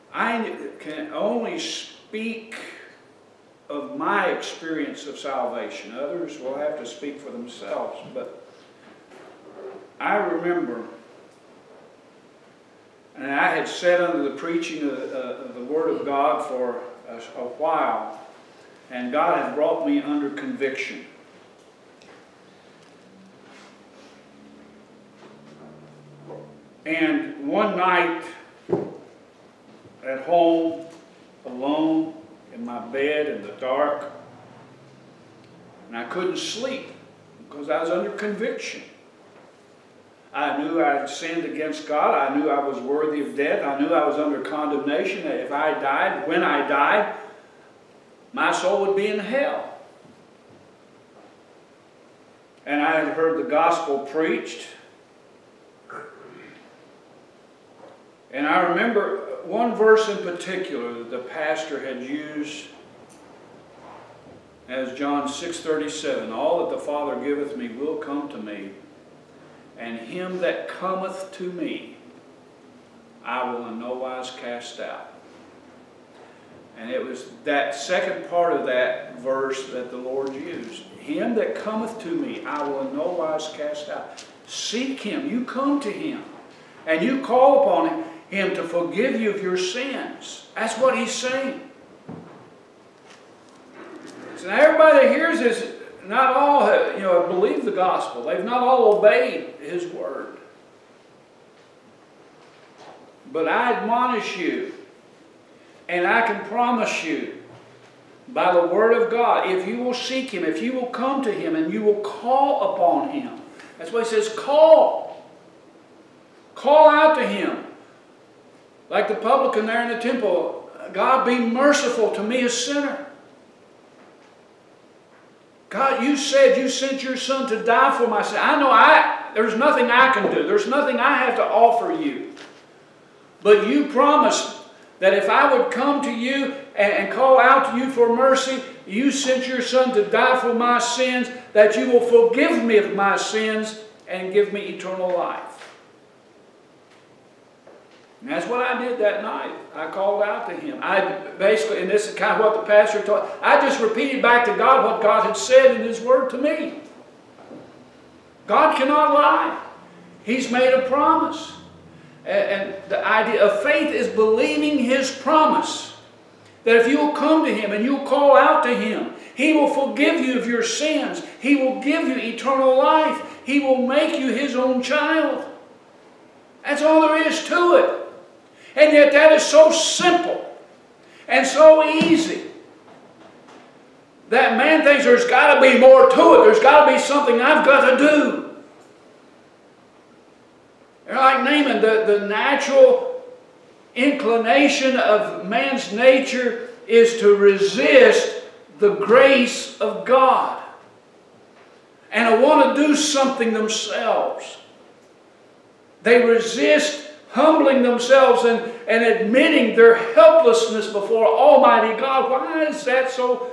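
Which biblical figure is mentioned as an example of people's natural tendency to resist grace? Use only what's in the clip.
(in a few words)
Naaman.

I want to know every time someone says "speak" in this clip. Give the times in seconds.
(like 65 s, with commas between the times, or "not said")
1 s, 6 s.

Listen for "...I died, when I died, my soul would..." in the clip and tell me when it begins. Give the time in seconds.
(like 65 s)
45 s.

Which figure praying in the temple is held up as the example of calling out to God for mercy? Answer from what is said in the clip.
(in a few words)
The publican.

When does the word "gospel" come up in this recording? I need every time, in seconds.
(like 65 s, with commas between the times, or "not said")
53 s, 97 s.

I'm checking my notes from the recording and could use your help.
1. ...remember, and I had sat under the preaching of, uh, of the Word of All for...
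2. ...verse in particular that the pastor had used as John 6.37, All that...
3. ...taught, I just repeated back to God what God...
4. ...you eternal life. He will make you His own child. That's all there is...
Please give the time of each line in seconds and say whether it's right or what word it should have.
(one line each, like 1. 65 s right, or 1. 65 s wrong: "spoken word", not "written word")
1. 10 s wrong: "God", not "All"
2. 59 s right
3. 153 s right
4. 172 s right.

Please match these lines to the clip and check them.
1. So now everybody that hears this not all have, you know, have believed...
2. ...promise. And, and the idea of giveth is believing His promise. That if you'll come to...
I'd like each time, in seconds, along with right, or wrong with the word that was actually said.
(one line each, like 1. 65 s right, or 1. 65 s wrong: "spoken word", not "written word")
1. 94 s right
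2. 160 s wrong: "faith", not "giveth".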